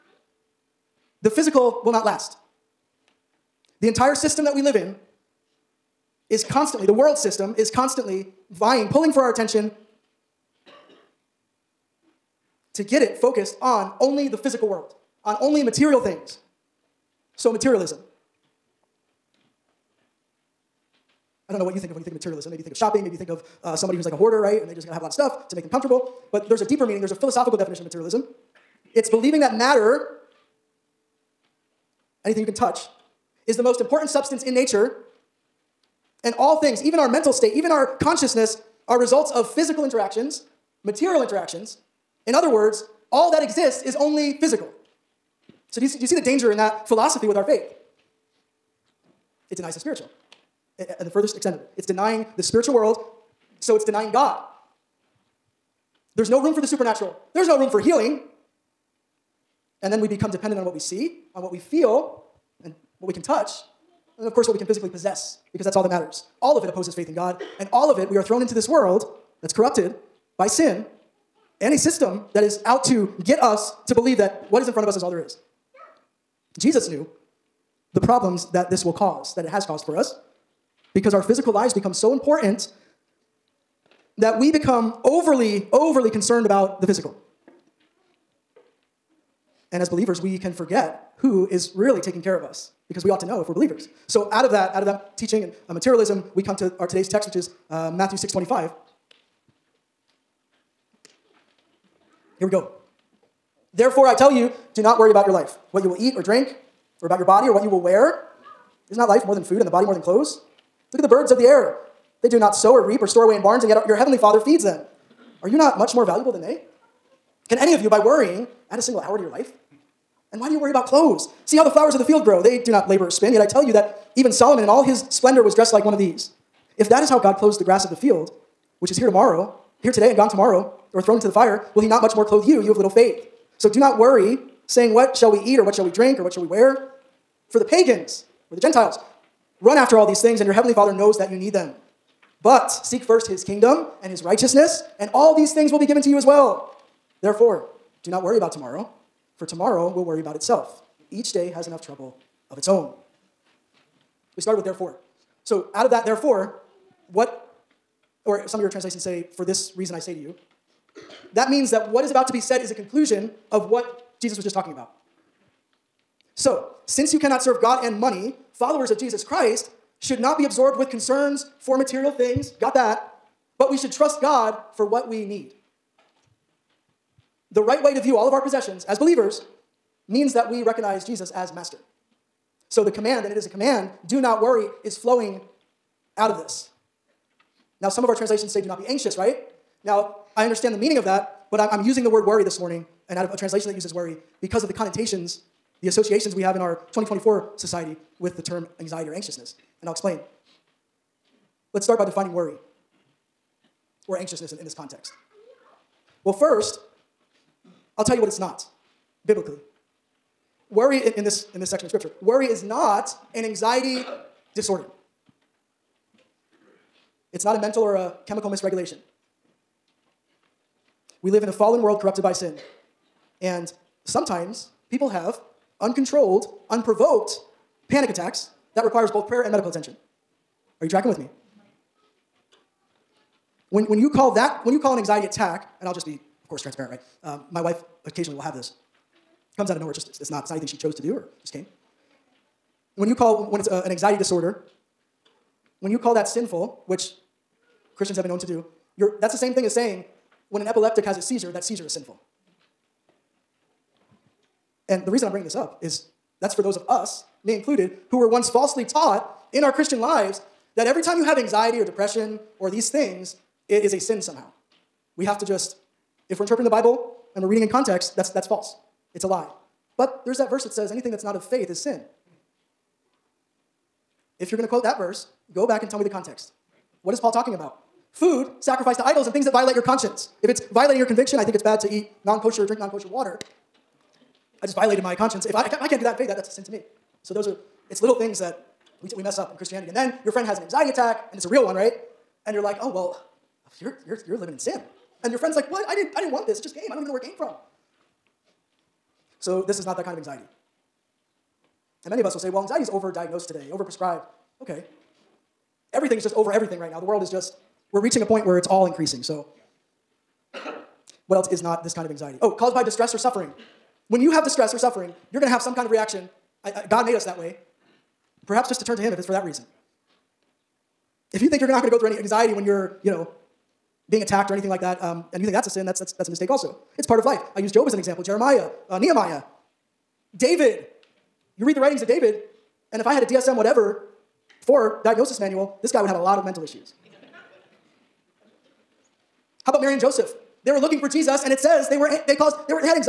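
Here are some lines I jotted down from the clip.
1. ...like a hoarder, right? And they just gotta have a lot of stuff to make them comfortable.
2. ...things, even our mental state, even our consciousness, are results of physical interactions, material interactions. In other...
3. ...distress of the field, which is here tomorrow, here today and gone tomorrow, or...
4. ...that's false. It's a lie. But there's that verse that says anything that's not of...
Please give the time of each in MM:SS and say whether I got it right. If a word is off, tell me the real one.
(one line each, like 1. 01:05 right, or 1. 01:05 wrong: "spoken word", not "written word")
1. 00:24 right
2. 00:36 right
3. 02:07 wrong: "grass", not "distress"
4. 04:28 right.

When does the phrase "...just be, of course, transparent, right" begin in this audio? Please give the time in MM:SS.
03:55.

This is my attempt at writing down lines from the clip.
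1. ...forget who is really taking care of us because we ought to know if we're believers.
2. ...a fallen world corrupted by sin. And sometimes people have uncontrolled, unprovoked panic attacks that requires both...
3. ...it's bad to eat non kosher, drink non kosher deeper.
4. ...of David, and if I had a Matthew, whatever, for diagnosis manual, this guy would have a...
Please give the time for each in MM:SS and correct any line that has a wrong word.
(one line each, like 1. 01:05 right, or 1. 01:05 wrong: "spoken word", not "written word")
1. 01:30 right
2. 03:41 right
3. 04:41 wrong: "water", not "deeper"
4. 05:32 wrong: "DSM", not "Matthew".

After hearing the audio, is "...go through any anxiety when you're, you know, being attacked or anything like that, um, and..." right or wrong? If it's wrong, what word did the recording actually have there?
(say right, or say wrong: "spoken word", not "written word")
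right.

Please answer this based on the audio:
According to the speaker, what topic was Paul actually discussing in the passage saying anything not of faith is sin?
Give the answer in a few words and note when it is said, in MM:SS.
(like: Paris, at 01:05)
Food sacrificed to idols, at 04:38.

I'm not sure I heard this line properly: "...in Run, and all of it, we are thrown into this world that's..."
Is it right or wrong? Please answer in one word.
wrong.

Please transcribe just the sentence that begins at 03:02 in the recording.
So the command, and it is a command, do not worry, is flowing out of this.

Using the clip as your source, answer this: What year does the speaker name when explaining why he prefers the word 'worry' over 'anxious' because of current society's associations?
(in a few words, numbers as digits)
2024.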